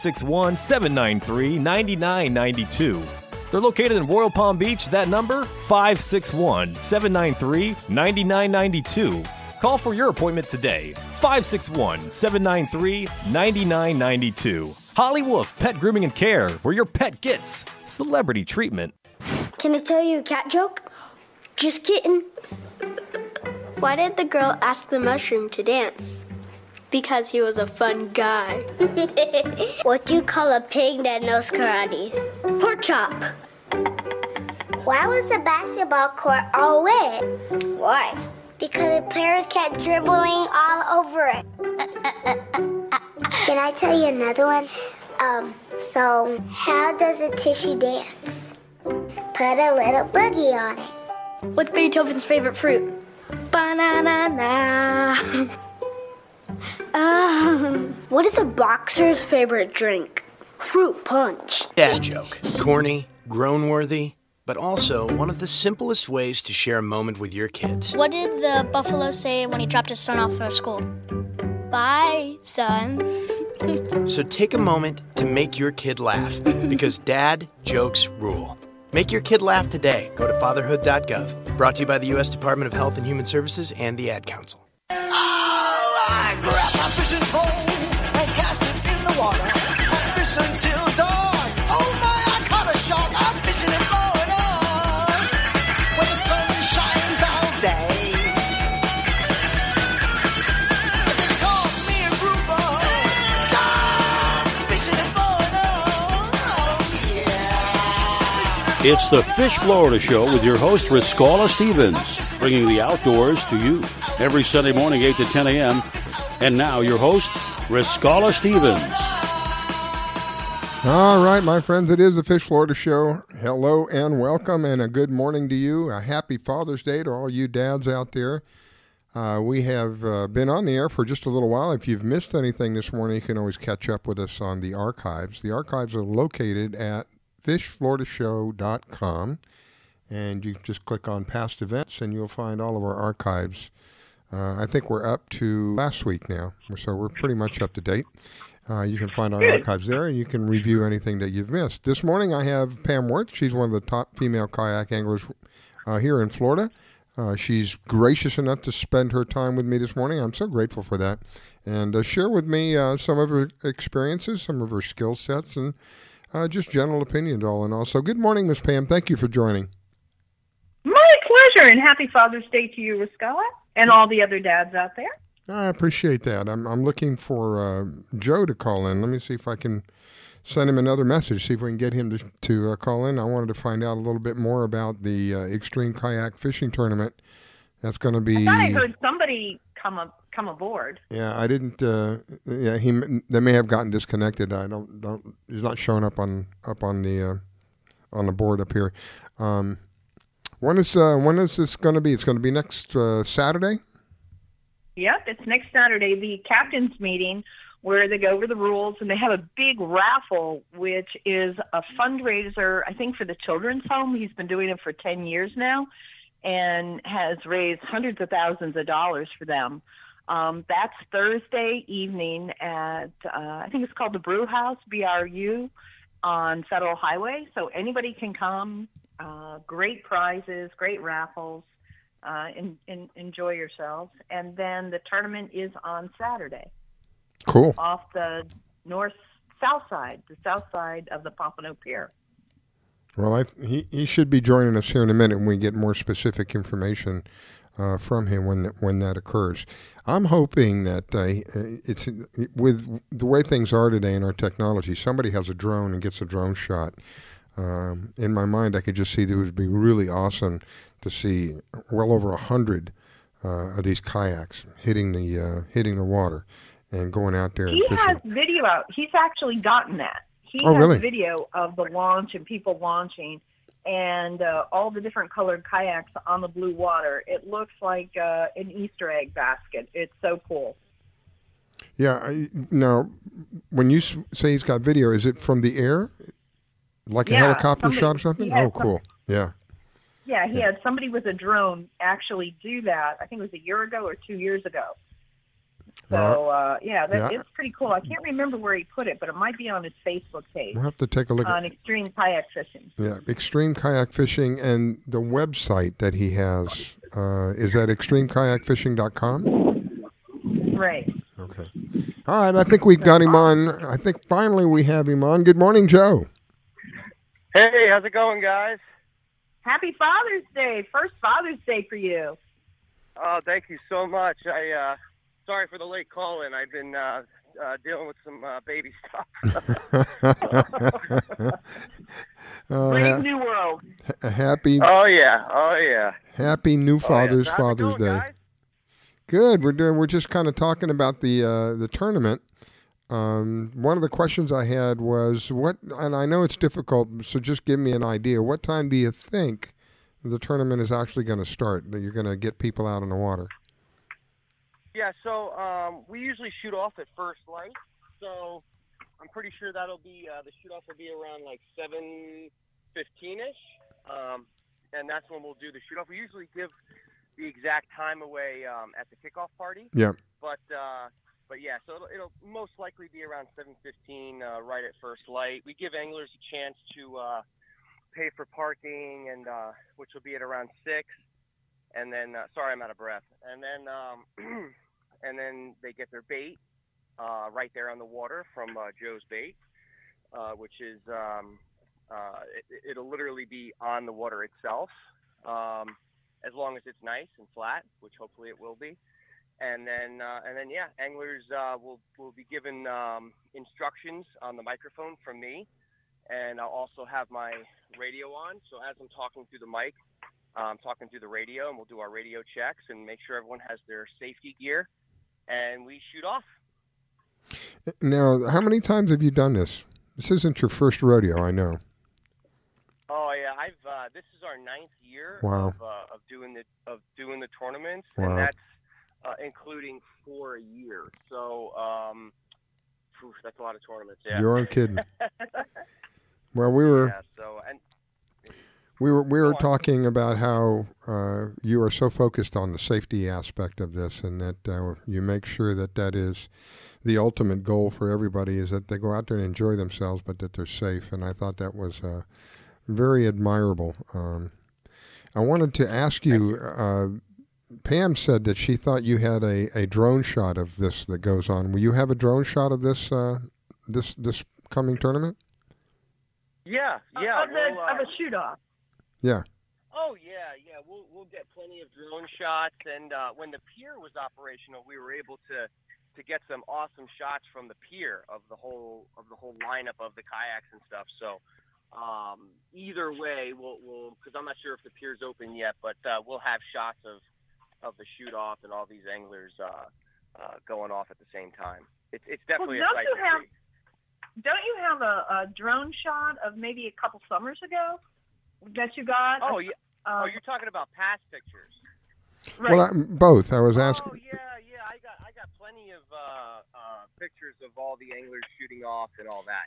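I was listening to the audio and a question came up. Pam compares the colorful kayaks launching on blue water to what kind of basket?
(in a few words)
Easter egg basket.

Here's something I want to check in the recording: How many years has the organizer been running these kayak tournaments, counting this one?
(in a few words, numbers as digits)
9.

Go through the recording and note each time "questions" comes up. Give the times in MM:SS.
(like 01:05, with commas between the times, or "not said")
05:44.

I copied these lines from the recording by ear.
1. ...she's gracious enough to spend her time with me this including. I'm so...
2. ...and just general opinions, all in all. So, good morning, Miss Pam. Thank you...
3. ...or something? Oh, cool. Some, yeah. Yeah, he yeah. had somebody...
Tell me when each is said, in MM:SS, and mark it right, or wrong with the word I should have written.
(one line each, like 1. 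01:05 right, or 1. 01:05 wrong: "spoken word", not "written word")
1. 02:37 wrong: "morning", not "including"
2. 02:45 right
3. 04:48 right.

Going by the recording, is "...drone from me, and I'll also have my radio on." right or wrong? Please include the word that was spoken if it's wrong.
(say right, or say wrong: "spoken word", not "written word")
wrong: "microphone", not "drone".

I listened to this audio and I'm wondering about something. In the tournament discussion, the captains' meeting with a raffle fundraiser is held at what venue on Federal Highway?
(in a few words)
Brew House.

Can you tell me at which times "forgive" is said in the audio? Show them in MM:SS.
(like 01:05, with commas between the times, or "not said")
not said.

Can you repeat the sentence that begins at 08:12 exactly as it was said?
It's it's definitely well, don't a sight you have, see.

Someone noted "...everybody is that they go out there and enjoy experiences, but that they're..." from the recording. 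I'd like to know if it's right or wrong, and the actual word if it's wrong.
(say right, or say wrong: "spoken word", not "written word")
wrong: "themselves", not "experiences".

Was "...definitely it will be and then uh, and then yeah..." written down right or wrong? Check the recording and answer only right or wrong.
wrong.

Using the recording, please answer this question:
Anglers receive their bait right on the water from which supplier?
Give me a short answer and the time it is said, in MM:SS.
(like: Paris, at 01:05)
Joe's Bait, at 06:28.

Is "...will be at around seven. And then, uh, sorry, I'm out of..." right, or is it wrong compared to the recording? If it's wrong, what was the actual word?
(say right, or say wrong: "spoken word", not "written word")
wrong: "six", not "seven".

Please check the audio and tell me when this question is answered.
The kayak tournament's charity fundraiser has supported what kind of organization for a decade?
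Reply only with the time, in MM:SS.
03:33.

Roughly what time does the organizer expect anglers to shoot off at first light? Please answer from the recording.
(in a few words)
7:15.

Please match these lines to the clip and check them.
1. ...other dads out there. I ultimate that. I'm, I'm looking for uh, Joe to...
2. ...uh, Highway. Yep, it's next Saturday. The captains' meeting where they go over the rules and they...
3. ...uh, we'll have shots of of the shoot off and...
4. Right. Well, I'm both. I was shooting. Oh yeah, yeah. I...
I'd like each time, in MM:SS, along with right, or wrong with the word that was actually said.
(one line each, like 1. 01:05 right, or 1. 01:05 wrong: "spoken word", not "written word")
1. 02:54 wrong: "appreciate", not "ultimate"
2. 03:22 wrong: "Saturday", not "Highway"
3. 08:06 right
4. 08:22 wrong: "asking", not "shooting".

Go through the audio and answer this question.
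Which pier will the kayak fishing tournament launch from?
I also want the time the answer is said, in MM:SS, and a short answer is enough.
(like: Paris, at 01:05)
Pompano Pier, at 04:01.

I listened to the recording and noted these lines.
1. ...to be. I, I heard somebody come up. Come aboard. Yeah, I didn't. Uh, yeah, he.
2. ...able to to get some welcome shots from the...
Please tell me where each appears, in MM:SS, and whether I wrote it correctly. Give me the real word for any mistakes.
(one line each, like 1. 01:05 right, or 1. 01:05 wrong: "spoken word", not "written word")
1. 03:08 right
2. 07:55 wrong: "awesome", not "welcome".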